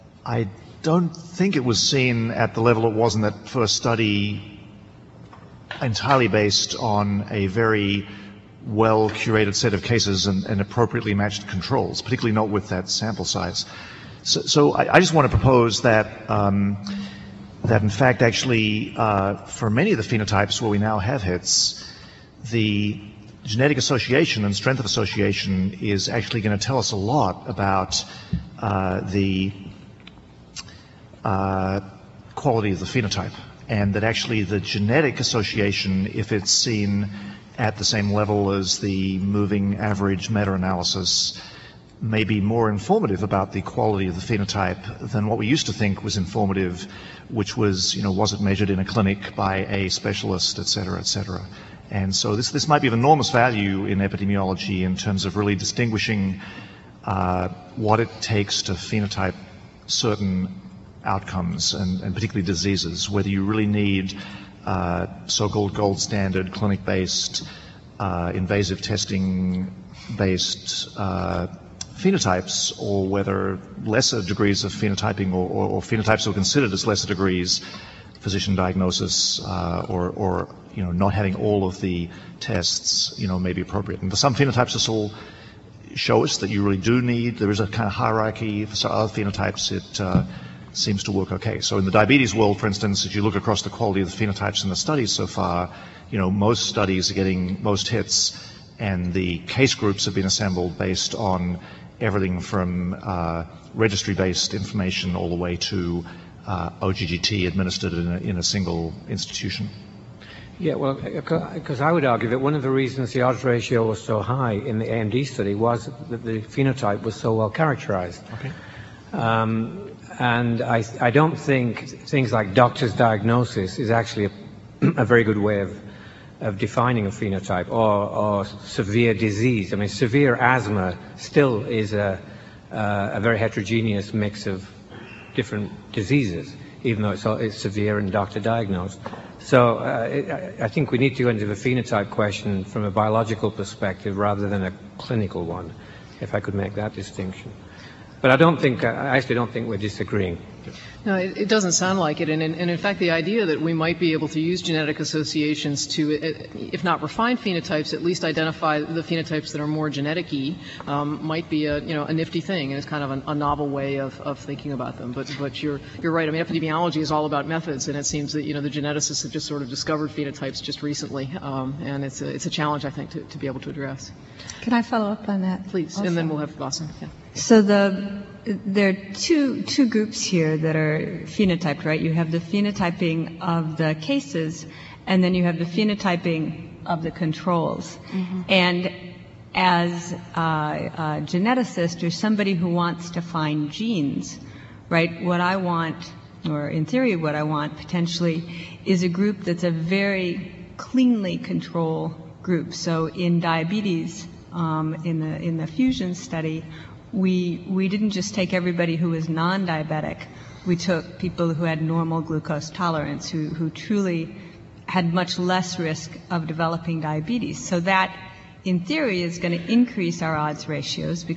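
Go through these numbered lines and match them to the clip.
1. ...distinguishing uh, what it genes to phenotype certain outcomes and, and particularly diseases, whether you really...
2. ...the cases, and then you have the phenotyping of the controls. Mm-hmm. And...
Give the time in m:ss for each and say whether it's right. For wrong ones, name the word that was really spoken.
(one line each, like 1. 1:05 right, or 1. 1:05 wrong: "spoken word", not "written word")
1. 0:55 wrong: "takes", not "genes"
2. 3:03 right.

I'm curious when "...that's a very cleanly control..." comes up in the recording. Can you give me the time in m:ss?
3:19.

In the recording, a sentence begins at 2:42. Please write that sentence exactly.
And it's kind of a novel way of, of thinking about them.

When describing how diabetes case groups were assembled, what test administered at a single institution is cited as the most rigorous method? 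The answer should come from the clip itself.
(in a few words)
OGTT.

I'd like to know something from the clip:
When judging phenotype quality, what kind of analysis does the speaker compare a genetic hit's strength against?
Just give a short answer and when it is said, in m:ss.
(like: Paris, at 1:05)
moving average meta-analysis, at 0:39.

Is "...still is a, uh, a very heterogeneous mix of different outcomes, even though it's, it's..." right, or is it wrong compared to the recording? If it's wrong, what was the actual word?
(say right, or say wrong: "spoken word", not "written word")
wrong: "diseases", not "outcomes".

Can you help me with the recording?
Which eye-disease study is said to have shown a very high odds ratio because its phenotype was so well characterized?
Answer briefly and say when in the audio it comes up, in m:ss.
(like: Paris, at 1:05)
AMD, at 1:54.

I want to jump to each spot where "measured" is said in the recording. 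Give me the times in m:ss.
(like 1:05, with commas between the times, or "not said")
0:48.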